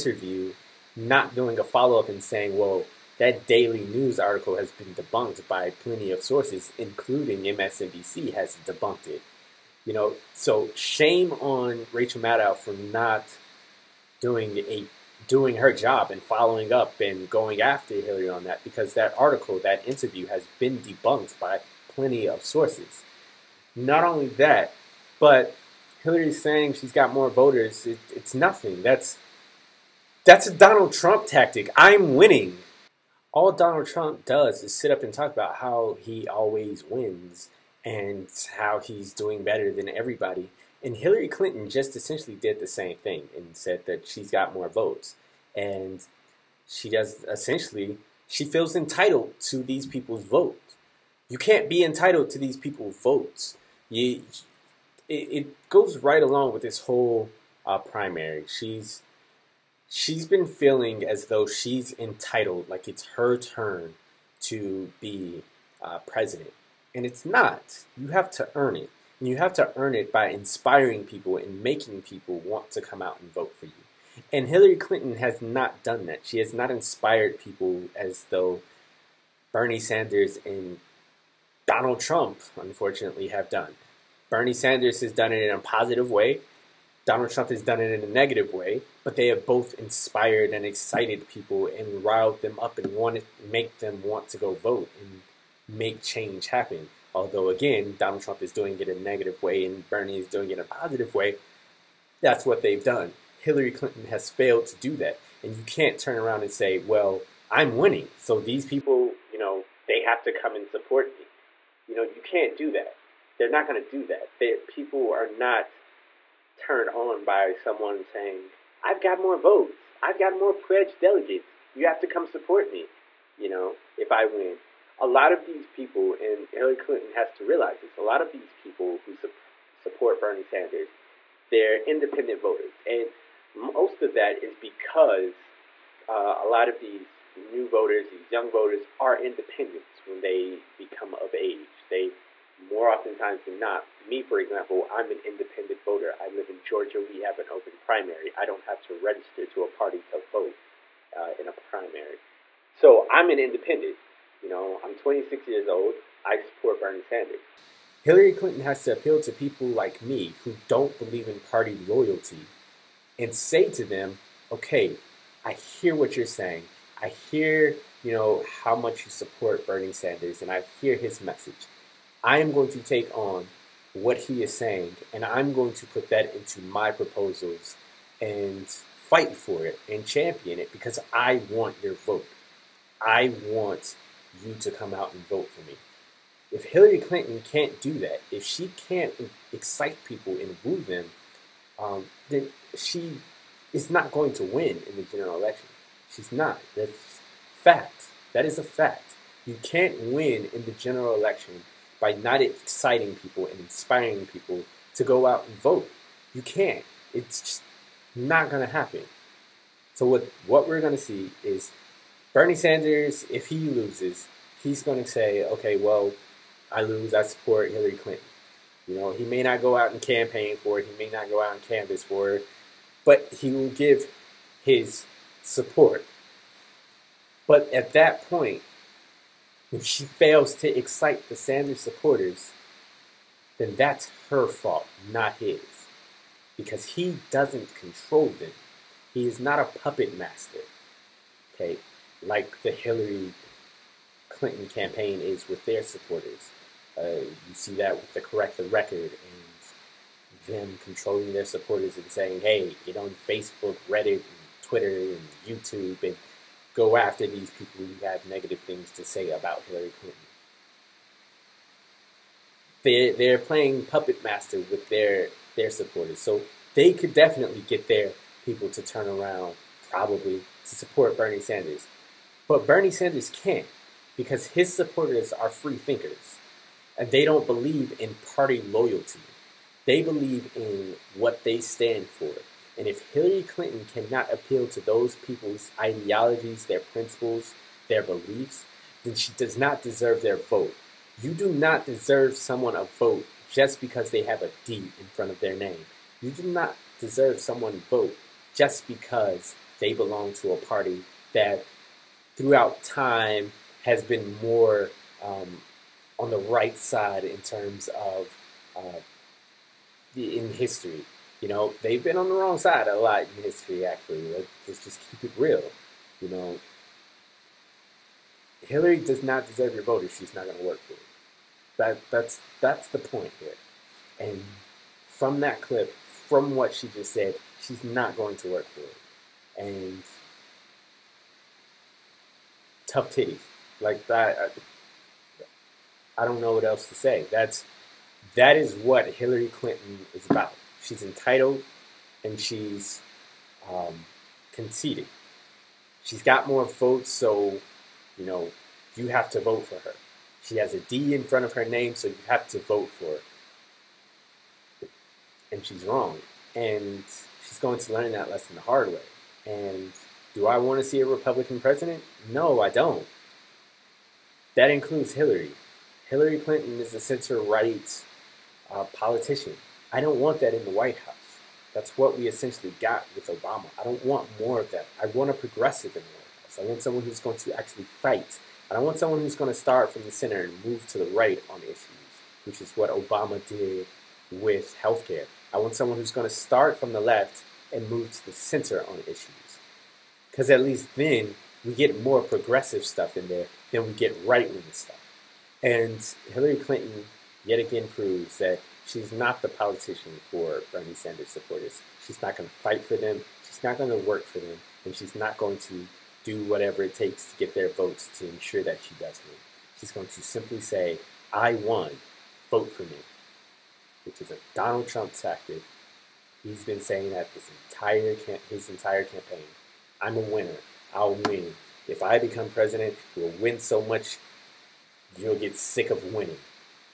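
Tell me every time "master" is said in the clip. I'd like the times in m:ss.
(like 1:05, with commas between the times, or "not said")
4:00, 4:24.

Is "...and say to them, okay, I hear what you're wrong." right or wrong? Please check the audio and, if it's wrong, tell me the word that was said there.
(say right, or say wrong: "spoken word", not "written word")
wrong: "saying", not "wrong".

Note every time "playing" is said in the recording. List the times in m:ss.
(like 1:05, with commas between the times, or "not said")
4:23.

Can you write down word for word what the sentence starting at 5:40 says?
She's entitled and she's um, conceited.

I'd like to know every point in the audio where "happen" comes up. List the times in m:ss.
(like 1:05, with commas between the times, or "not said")
1:36, 3:28.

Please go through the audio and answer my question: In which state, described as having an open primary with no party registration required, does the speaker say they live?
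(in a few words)
Georgia.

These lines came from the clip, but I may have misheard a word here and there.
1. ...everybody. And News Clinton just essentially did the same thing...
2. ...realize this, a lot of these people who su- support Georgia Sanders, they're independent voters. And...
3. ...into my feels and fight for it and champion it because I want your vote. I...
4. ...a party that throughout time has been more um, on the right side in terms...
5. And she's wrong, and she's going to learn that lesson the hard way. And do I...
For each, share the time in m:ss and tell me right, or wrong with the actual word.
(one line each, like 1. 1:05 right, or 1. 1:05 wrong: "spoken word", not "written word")
1. 0:39 wrong: "Hillary", not "News"
2. 2:07 wrong: "Bernie", not "Georgia"
3. 2:56 wrong: "proposals", not "feels"
4. 5:00 right
5. 5:55 right.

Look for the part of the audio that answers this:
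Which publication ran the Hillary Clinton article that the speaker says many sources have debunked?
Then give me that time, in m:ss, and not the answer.
0:03.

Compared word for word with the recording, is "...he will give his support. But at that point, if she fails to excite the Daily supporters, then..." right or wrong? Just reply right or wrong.
wrong.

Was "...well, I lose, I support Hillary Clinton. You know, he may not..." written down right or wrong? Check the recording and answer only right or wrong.
right.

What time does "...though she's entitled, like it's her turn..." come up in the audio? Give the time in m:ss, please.
1:01.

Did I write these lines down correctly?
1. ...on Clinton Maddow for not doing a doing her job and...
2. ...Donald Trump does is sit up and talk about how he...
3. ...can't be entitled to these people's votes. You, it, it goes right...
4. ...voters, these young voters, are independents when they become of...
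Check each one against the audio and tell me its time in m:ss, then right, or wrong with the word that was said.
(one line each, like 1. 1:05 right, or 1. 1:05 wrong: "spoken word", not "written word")
1. 0:11 wrong: "Rachel", not "Clinton"
2. 0:33 right
3. 0:51 right
4. 2:17 right.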